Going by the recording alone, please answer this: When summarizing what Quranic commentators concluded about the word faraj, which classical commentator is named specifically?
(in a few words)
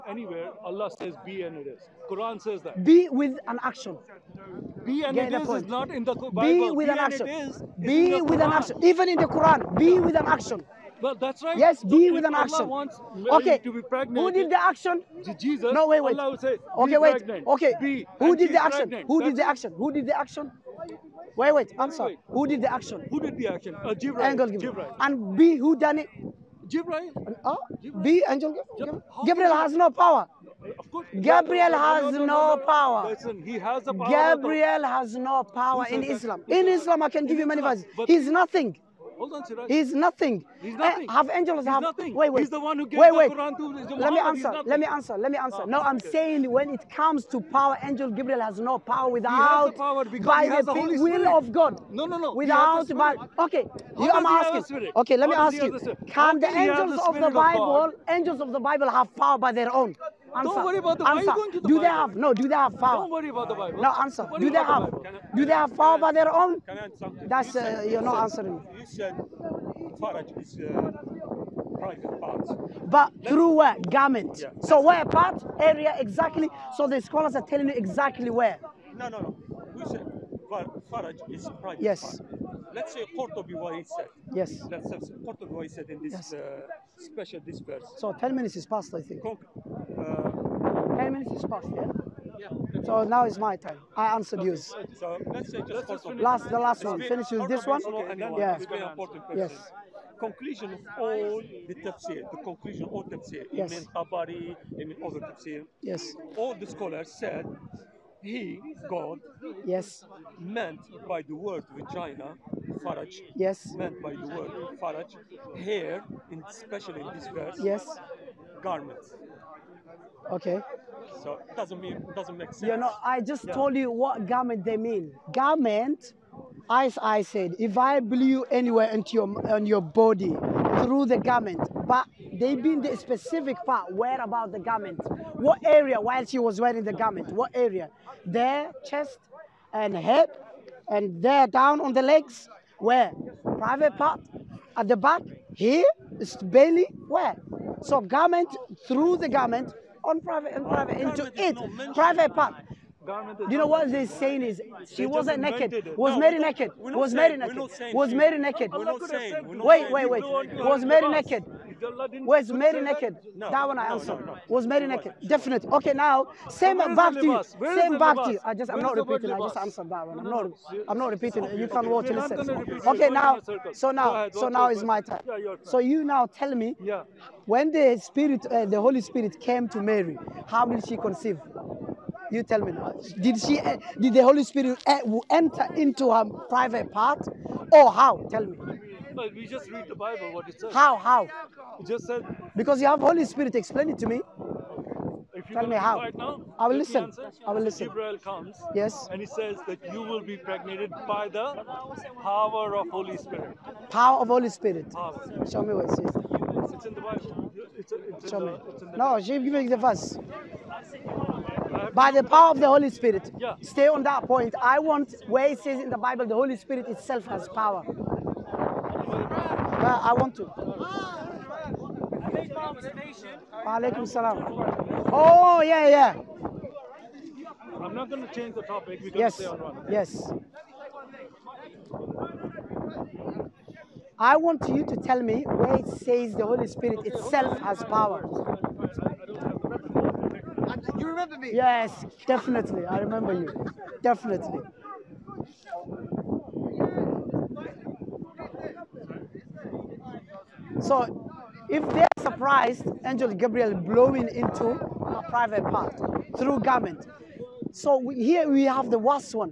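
Ibn Tabari.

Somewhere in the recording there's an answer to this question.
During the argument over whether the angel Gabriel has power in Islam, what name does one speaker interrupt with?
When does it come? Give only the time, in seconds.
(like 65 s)
39 s.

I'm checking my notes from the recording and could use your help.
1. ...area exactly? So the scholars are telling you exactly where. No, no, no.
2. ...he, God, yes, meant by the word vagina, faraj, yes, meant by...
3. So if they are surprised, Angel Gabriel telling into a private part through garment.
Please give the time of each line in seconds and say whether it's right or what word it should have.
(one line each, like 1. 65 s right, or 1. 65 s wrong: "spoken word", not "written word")
1. 75 s right
2. 108 s right
3. 250 s wrong: "blowing", not "telling".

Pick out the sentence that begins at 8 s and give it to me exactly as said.
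Even in the Quran, be with an action.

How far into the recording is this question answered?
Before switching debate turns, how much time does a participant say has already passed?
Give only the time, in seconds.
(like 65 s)
88 s.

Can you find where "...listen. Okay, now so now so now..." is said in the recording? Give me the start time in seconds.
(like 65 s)
172 s.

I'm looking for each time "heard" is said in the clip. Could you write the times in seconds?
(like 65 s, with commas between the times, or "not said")
not said.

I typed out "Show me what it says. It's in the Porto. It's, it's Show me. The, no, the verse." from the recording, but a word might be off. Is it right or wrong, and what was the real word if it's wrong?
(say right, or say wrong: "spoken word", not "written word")
wrong: "Bible", not "Porto".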